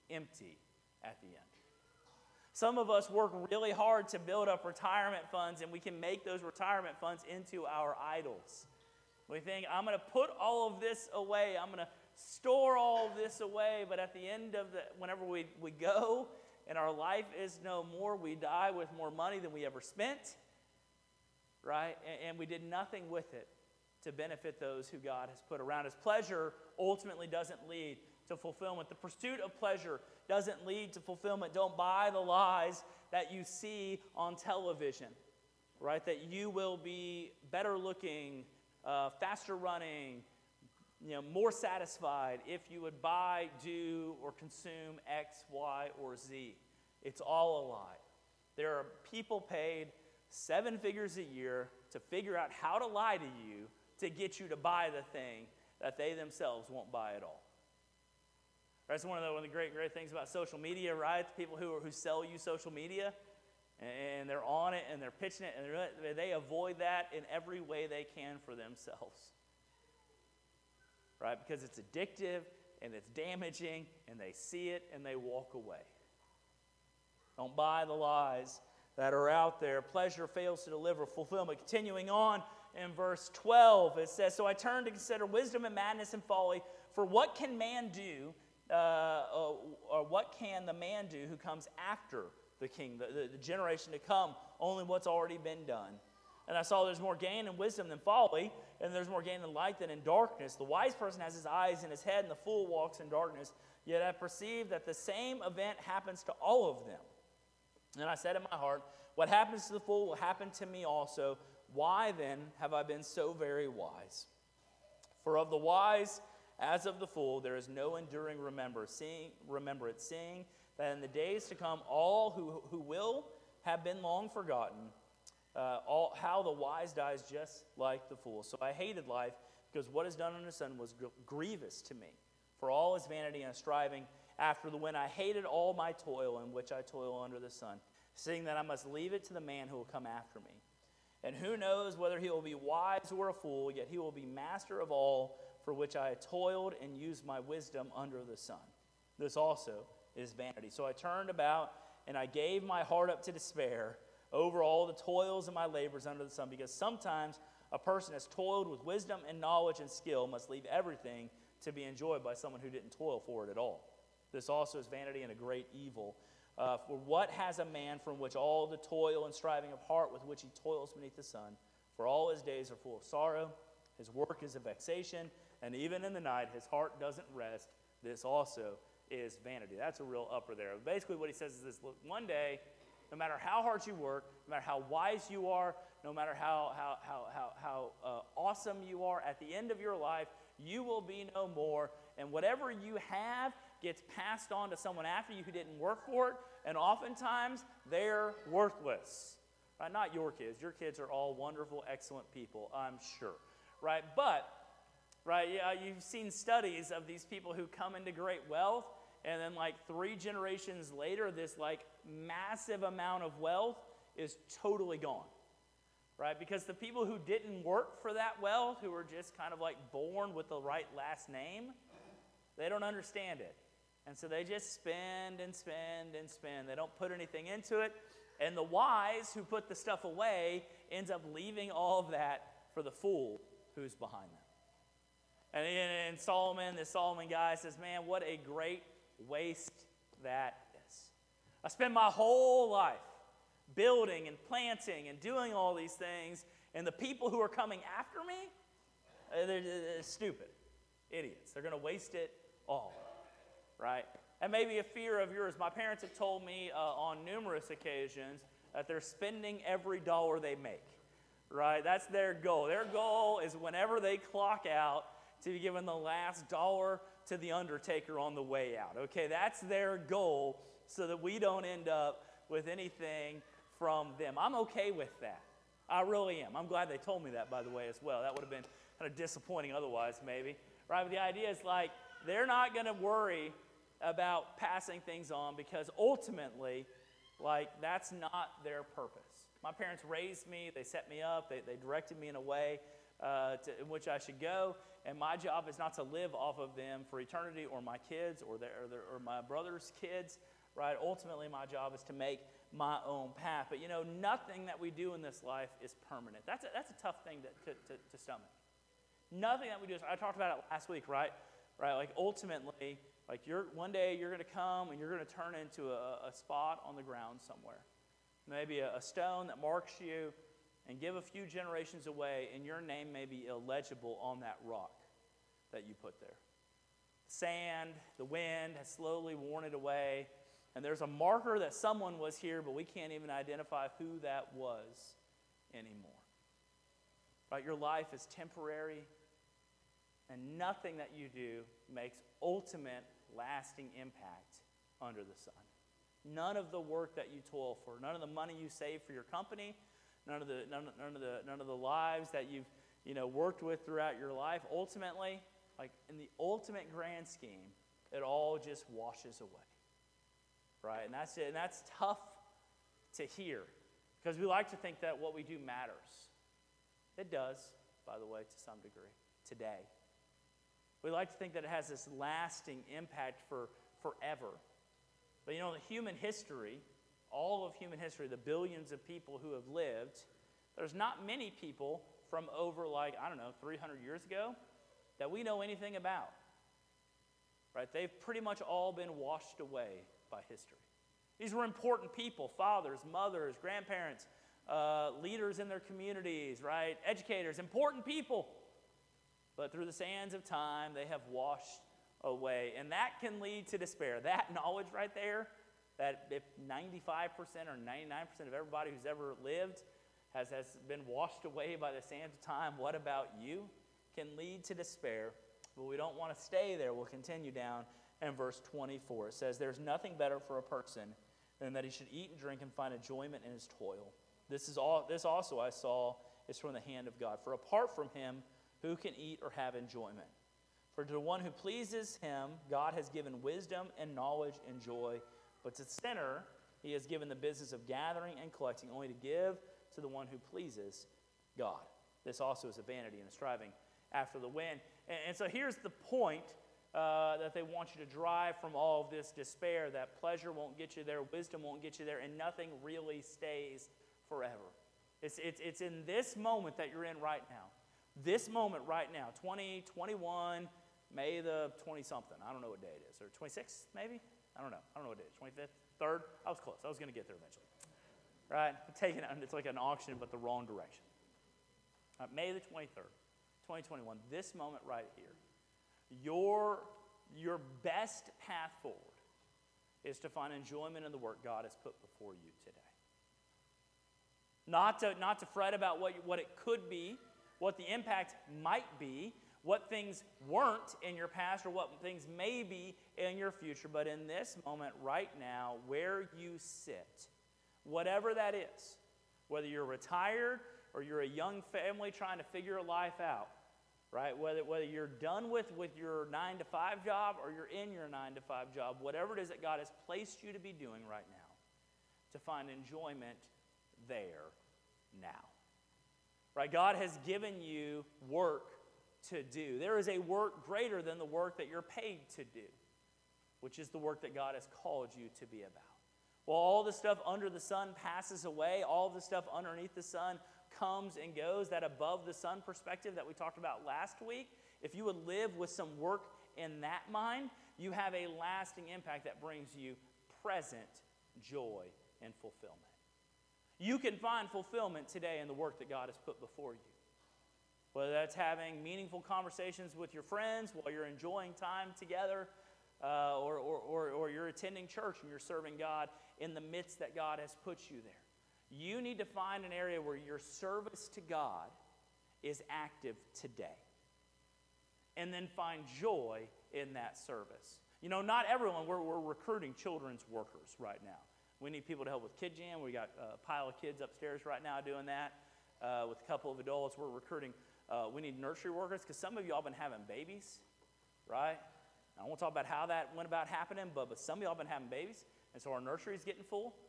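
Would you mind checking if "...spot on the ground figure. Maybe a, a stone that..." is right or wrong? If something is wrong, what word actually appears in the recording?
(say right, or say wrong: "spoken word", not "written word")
wrong: "somewhere", not "figure".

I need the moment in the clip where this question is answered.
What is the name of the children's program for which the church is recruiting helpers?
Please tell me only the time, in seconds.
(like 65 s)
572 s.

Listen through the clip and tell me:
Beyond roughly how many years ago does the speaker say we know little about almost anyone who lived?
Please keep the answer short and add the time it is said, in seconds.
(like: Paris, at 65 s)
300, at 383 s.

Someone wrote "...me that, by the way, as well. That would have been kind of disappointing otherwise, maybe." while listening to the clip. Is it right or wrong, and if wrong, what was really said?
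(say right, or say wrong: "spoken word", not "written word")
right.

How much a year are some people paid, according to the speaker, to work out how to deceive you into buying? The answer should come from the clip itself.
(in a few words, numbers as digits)
seven figures.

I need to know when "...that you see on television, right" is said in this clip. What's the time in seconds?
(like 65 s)
33 s.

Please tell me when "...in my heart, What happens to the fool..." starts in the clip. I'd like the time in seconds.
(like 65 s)
108 s.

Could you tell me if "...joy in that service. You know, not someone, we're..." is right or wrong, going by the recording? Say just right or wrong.
wrong.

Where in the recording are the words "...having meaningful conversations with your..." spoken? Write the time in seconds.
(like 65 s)
548 s.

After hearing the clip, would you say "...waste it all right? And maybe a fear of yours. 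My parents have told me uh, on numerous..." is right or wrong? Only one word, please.
right.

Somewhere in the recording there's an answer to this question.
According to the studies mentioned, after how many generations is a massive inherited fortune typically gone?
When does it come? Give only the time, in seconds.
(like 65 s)
209 s.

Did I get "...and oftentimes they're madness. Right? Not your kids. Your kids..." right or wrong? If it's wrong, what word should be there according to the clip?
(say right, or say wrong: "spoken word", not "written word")
wrong: "worthless", not "madness".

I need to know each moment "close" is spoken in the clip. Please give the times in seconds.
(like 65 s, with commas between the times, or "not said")
466 s.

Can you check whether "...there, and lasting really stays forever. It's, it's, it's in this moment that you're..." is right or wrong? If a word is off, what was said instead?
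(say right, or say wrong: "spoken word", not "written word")
wrong: "nothing", not "lasting".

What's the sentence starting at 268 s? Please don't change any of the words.
Okay, that's their goal so that we don't end up with anything from them.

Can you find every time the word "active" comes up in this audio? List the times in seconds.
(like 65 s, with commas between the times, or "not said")
562 s.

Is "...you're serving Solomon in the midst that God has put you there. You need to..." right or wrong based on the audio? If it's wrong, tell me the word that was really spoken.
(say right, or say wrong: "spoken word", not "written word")
wrong: "God", not "Solomon".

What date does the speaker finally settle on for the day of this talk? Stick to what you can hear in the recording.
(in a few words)
May 23rd, 2021.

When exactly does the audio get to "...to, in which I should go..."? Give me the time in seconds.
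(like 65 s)
293 s.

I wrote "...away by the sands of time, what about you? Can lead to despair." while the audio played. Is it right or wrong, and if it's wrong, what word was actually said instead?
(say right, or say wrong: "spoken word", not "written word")
right.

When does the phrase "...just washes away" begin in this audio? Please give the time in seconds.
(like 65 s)
358 s.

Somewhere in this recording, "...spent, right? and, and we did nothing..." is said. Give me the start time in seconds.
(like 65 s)
19 s.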